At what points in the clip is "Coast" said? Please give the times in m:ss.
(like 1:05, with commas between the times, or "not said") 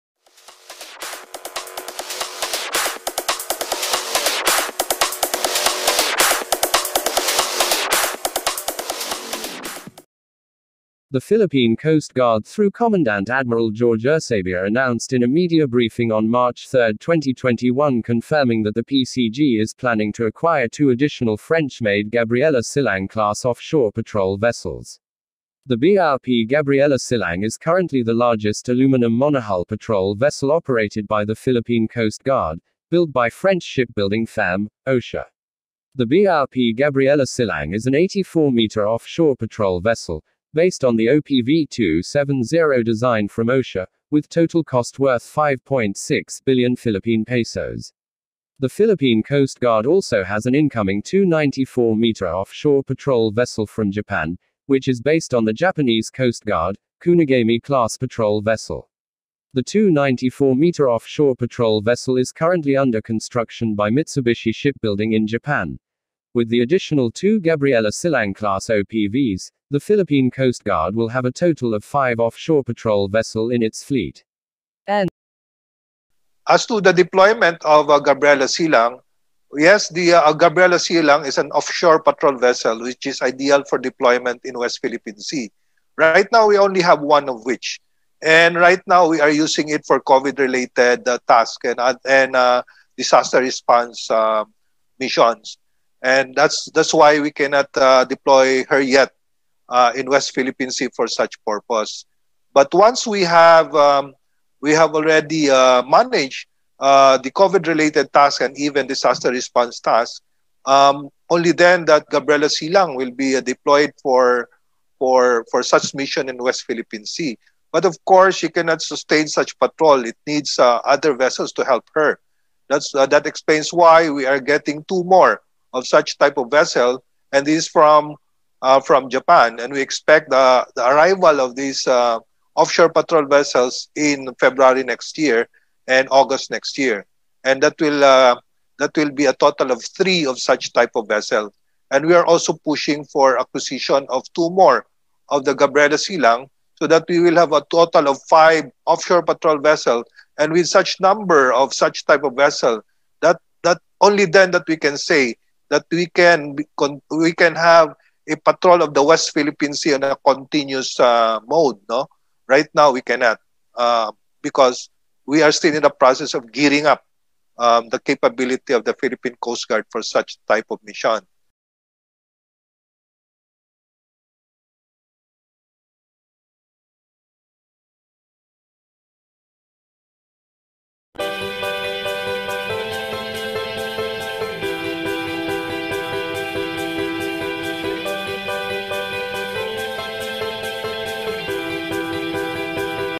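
0:11, 0:31, 0:49, 0:56, 1:10, 2:49.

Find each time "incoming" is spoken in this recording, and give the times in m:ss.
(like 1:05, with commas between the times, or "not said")
0:50.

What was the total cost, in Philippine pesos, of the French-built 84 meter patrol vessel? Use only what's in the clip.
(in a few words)
5.6 billion pesos.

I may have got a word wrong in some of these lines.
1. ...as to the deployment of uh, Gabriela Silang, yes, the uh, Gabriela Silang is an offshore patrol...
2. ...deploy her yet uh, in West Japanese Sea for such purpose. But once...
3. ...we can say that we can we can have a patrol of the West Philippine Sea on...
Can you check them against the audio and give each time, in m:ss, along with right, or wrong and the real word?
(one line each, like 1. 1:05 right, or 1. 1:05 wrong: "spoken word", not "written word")
1. 1:16 right
2. 1:38 wrong: "Philippine", not "Japanese"
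3. 2:34 right.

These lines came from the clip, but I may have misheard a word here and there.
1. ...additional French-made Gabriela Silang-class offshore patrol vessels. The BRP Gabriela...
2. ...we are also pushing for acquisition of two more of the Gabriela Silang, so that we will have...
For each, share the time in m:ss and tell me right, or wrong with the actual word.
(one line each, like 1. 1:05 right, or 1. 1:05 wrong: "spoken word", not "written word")
1. 0:20 right
2. 2:22 right.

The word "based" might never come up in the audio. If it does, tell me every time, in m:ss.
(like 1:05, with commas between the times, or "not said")
0:40, 0:55.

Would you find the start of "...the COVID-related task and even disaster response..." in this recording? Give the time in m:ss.
1:47.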